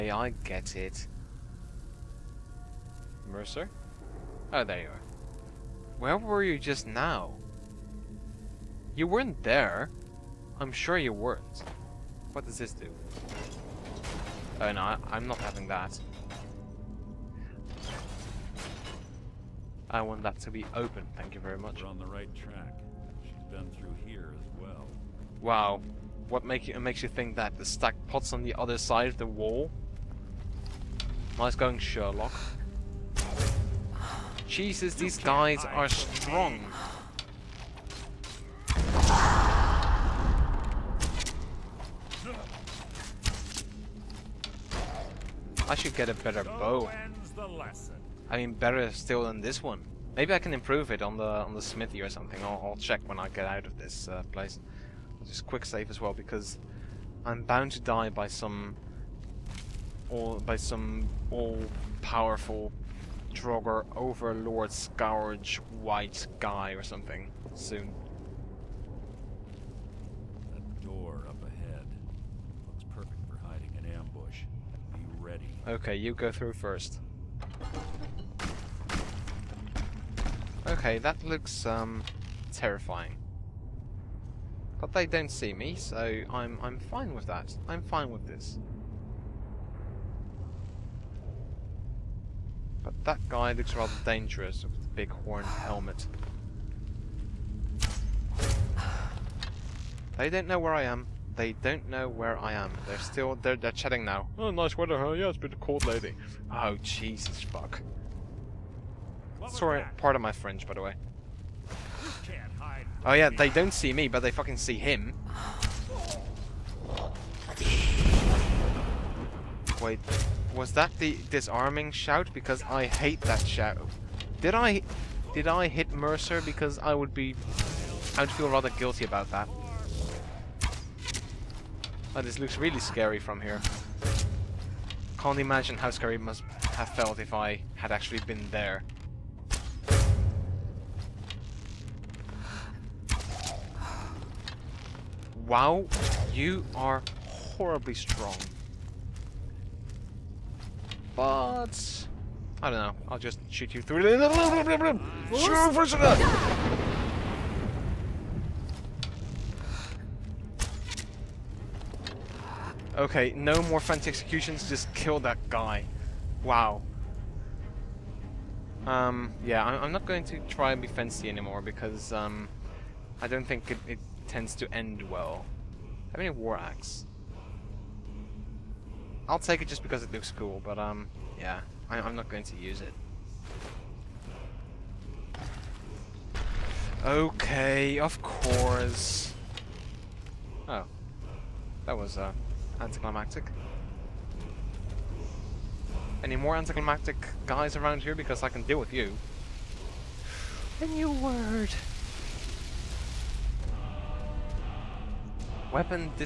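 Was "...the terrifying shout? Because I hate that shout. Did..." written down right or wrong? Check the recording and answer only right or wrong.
wrong.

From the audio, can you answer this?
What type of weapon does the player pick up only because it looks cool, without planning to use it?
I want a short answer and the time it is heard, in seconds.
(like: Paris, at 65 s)
War Axe, at 176 s.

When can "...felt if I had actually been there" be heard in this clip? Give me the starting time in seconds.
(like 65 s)
136 s.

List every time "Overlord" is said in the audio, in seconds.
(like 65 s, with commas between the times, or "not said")
63 s.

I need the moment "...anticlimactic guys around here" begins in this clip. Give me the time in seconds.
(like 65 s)
196 s.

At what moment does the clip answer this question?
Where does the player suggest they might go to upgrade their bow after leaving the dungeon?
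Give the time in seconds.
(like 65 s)
51 s.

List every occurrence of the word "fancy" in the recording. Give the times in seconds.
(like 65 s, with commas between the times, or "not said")
163 s, 170 s.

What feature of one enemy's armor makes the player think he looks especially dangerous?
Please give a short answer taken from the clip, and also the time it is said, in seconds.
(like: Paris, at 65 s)
big horned helmet, at 94 s.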